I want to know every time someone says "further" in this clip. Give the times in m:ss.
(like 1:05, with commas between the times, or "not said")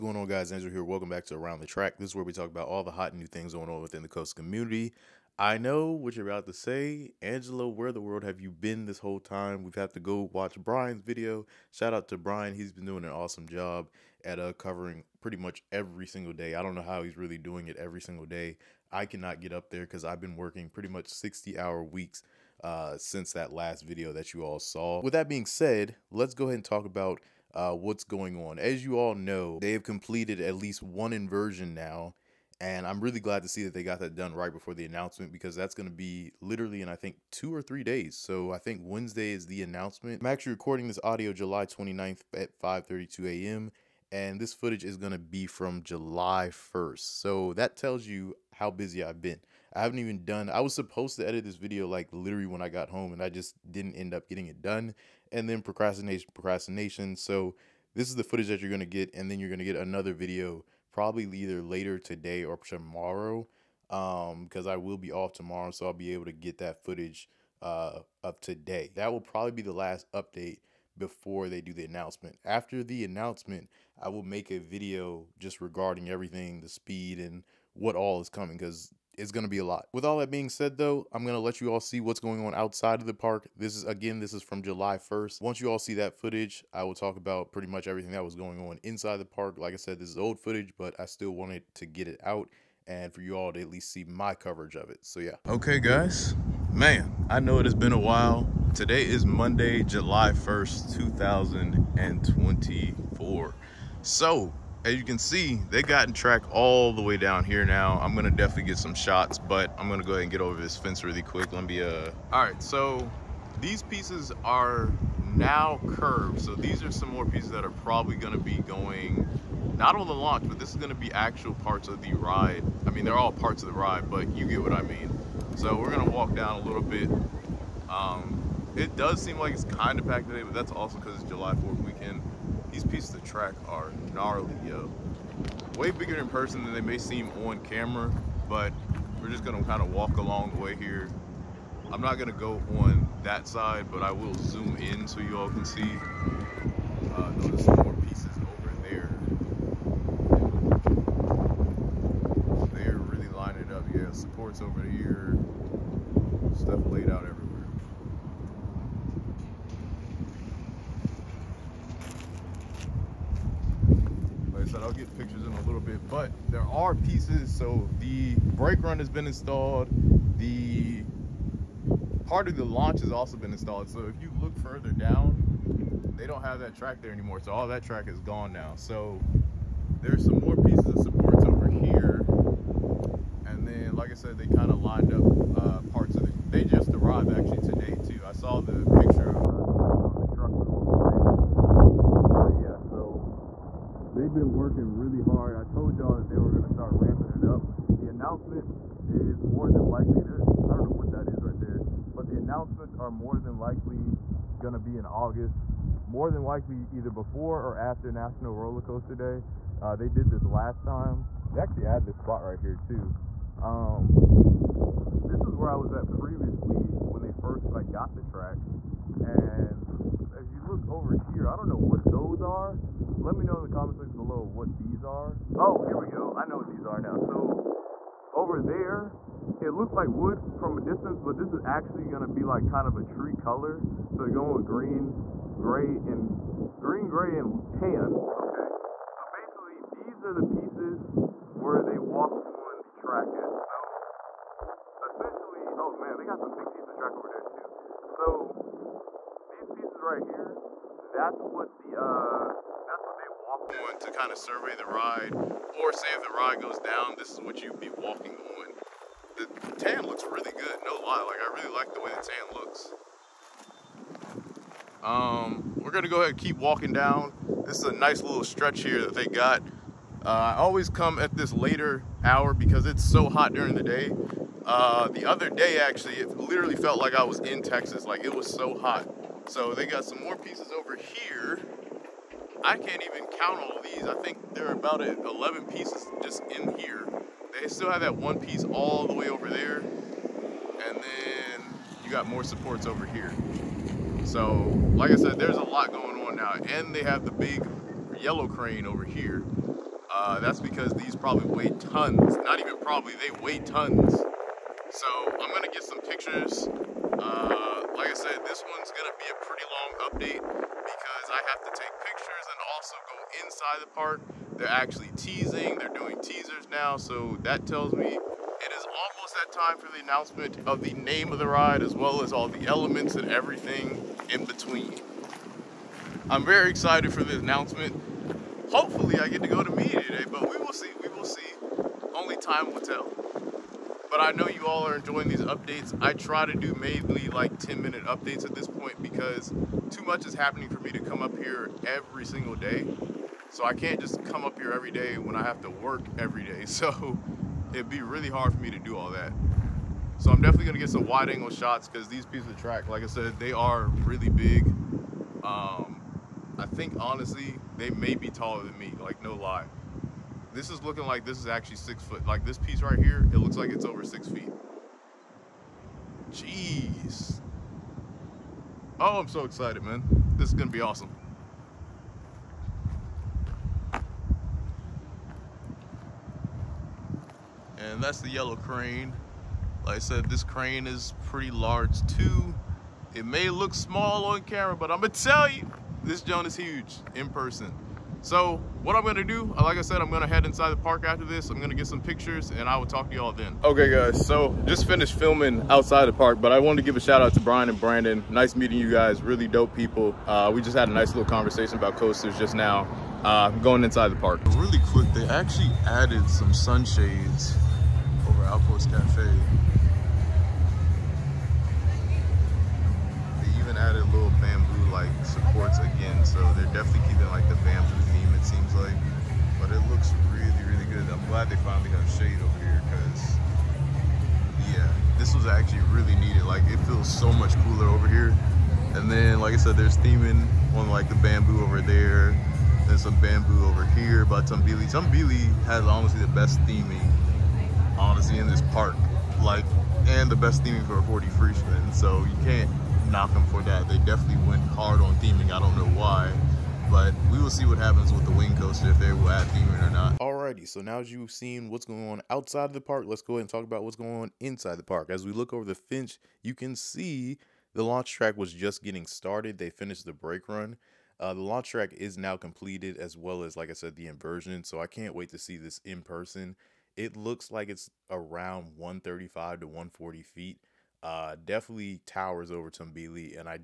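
2:54.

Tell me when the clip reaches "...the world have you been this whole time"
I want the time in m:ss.
0:07.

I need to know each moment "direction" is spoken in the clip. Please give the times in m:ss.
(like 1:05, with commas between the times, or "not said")
not said.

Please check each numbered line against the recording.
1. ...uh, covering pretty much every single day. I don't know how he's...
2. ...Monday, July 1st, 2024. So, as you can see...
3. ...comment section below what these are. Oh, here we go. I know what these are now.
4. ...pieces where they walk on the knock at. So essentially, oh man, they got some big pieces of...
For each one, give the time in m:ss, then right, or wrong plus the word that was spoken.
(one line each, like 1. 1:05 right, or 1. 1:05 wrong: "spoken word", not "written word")
1. 0:14 right
2. 1:39 right
3. 3:43 right
4. 4:00 wrong: "track", not "knock".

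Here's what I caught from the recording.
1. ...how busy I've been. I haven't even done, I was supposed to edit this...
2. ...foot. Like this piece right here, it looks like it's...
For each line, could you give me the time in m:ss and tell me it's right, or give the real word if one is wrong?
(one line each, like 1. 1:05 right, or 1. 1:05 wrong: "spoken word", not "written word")
1. 0:48 right
2. 6:02 right.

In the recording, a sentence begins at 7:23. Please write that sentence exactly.
They definitely went hard on we'll see what happens with the wing coaster if they will add theming or not.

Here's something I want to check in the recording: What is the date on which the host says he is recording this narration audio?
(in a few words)
July 29.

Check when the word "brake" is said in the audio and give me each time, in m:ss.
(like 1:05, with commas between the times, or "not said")
2:48, 7:40.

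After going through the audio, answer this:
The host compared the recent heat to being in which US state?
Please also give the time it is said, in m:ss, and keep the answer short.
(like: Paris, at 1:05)
Texas, at 4:37.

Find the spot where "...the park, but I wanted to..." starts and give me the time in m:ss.
6:36.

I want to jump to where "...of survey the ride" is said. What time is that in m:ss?
4:14.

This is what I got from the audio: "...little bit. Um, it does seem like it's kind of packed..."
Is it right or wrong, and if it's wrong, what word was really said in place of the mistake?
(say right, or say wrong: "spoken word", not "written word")
right.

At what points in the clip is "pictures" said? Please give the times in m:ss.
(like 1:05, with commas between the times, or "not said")
3:08, 5:06, 5:12, 6:32.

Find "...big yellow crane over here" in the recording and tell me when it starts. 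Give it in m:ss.
4:57.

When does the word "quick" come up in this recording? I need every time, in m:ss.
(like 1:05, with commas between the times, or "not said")
1:51, 6:44.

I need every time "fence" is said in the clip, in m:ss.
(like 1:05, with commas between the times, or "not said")
1:50, 7:35.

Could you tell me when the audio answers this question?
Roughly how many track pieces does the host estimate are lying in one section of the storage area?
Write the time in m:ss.
4:44.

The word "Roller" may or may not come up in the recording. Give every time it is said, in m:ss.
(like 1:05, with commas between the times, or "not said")
3:28.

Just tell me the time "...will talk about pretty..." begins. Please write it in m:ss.
1:26.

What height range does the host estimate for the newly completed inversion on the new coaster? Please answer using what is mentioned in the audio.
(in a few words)
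135 to 140 feet.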